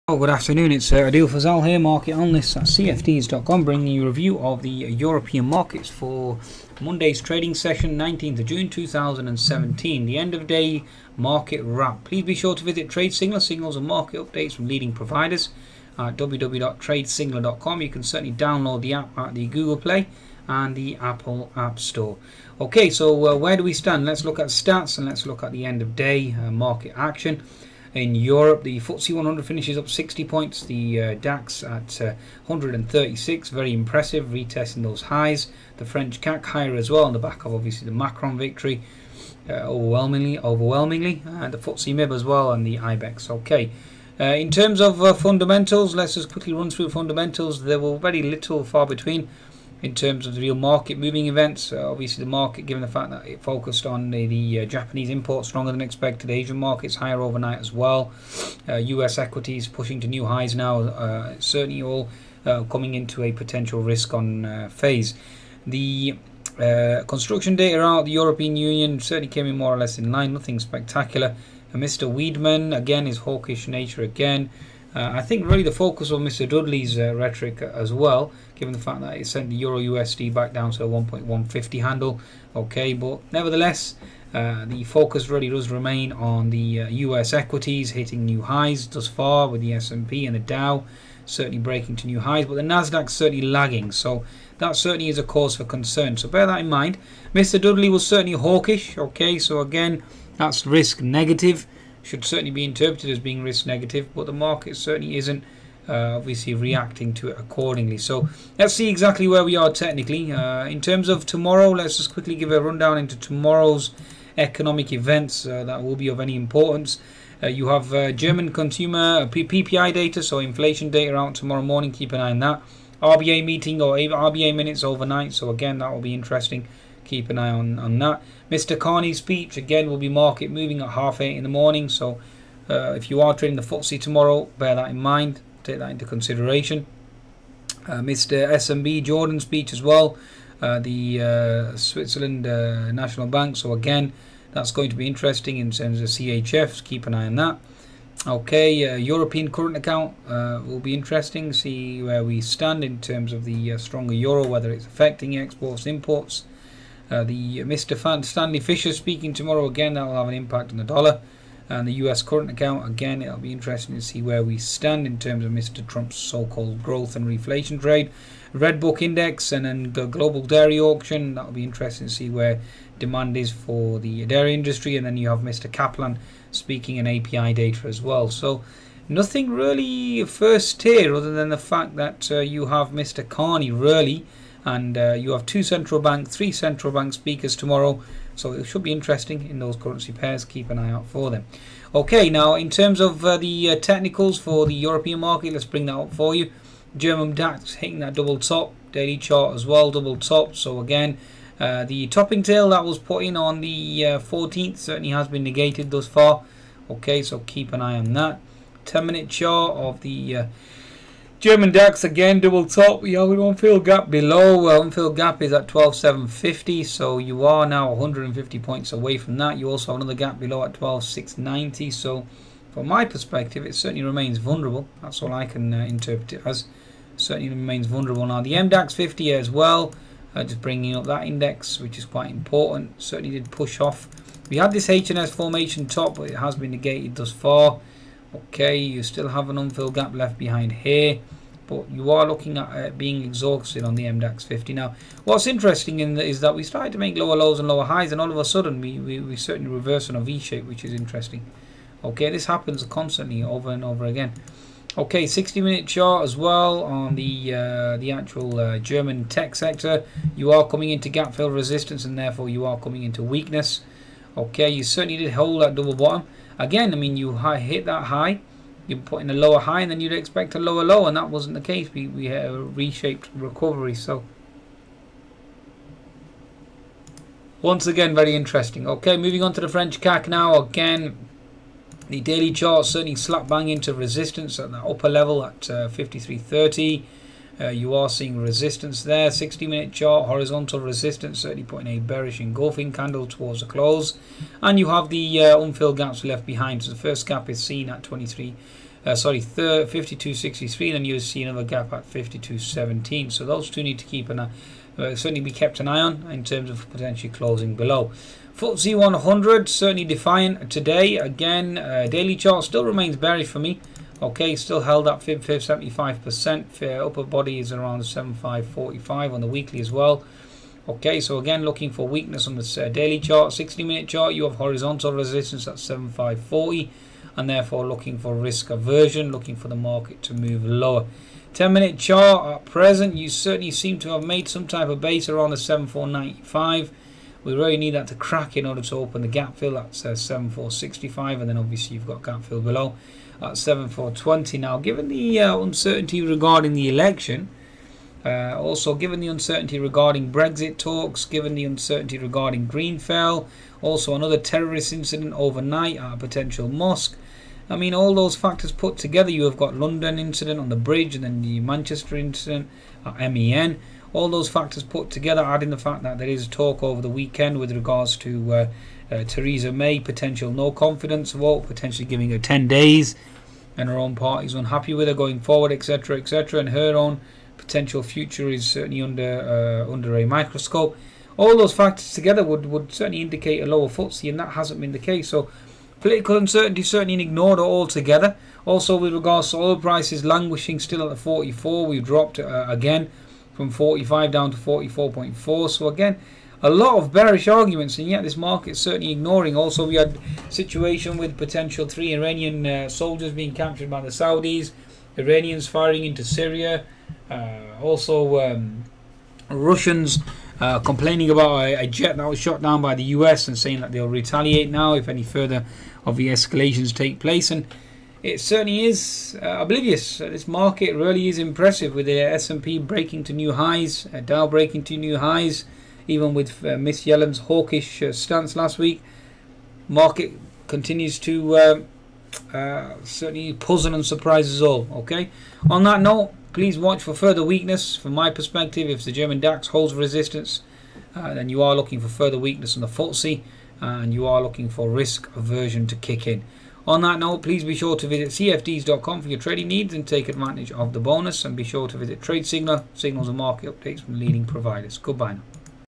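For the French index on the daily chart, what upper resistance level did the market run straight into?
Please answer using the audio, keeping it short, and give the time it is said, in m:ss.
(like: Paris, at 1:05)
53.30, at 4:45.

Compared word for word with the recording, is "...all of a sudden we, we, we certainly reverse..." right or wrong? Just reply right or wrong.
right.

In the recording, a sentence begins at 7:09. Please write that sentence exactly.
Market continues to uh, certainly puzzle and surprise us all.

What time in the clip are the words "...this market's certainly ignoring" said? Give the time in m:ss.
6:38.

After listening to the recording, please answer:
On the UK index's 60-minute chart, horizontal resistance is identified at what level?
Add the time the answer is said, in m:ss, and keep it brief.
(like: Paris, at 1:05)
7540, at 5:25.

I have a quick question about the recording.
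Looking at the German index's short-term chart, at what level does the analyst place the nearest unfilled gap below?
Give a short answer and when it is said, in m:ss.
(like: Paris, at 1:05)
12,750, at 3:35.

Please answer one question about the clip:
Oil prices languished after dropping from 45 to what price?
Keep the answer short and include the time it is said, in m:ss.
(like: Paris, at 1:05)
44.4, at 6:34.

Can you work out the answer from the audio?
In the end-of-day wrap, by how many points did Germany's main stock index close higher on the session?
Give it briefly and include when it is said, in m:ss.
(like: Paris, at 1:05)
136, at 0:32.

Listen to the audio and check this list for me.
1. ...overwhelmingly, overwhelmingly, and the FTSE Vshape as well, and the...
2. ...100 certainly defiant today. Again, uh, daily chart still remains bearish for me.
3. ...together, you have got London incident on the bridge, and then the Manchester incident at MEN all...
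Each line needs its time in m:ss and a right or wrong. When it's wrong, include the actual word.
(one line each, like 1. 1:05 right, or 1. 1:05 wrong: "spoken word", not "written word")
1. 0:39 wrong: "MIB", not "Vshape"
2. 5:08 right
3. 5:58 right.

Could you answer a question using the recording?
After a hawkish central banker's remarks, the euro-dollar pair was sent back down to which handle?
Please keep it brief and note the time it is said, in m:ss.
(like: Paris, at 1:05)
1.150, at 1:20.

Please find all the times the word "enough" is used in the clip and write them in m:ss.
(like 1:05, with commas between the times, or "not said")
not said.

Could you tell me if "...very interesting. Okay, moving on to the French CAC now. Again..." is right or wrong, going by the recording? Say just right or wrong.
right.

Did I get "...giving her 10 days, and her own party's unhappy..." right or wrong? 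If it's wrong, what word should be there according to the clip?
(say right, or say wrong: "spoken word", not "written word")
right.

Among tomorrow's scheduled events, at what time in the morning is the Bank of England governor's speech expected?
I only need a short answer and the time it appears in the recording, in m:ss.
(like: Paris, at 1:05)
half eight, at 2:10.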